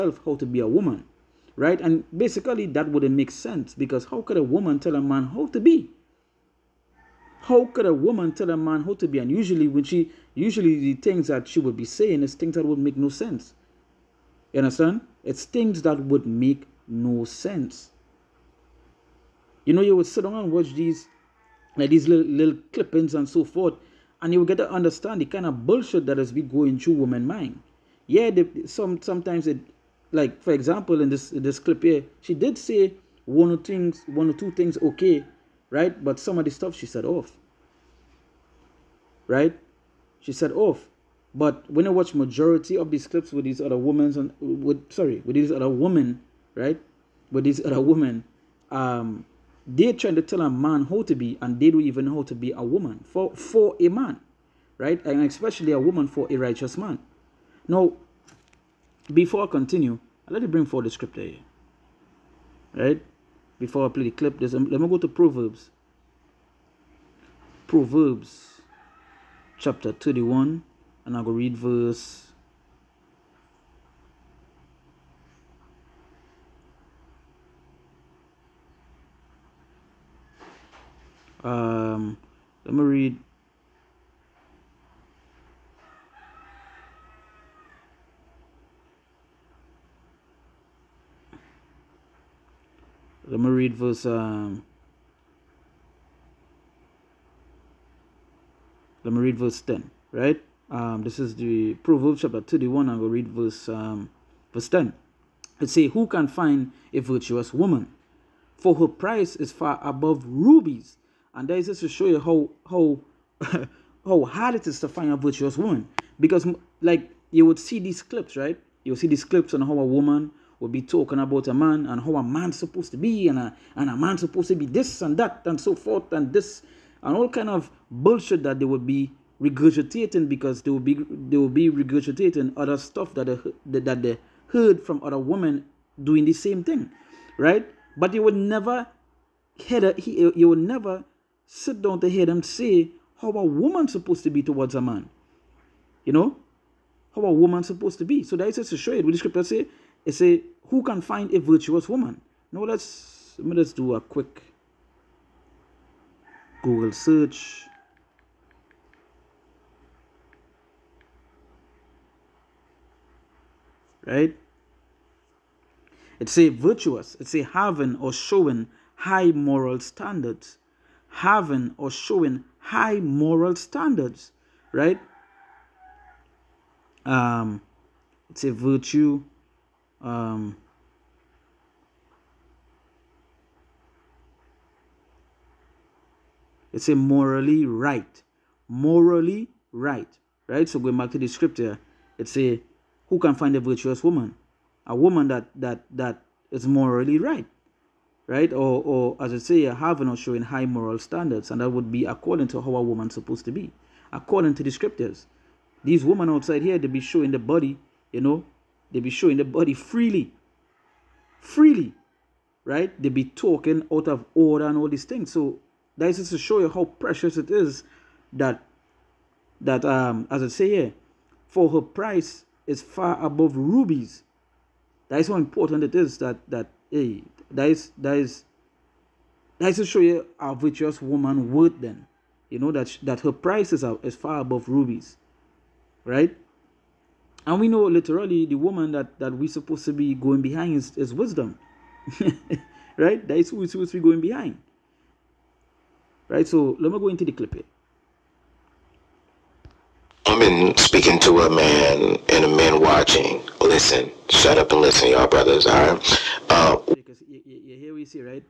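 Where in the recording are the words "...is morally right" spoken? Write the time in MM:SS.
03:16.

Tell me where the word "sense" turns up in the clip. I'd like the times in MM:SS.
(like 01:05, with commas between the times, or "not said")
00:03, 00:13, 00:17.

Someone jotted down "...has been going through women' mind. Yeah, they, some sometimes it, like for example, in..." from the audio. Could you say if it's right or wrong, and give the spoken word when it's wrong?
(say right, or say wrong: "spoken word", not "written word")
right.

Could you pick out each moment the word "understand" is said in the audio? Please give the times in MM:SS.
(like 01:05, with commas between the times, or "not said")
00:14, 00:24.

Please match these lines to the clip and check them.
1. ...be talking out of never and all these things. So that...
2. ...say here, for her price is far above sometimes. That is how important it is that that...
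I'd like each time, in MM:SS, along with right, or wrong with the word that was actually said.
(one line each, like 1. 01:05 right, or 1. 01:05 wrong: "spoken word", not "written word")
1. 03:33 wrong: "order", not "never"
2. 03:40 wrong: "rubies", not "sometimes".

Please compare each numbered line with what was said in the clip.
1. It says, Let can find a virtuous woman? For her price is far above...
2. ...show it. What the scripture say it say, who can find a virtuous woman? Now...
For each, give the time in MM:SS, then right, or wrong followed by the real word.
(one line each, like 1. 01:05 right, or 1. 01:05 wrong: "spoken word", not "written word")
1. 01:45 wrong: "Who", not "Let"
2. 02:28 right.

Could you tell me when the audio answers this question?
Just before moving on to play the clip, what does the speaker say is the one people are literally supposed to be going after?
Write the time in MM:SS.
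04:01.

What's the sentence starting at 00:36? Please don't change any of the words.
But some of the stuff she said off, right?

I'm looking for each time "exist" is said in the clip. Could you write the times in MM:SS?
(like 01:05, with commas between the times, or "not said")
not said.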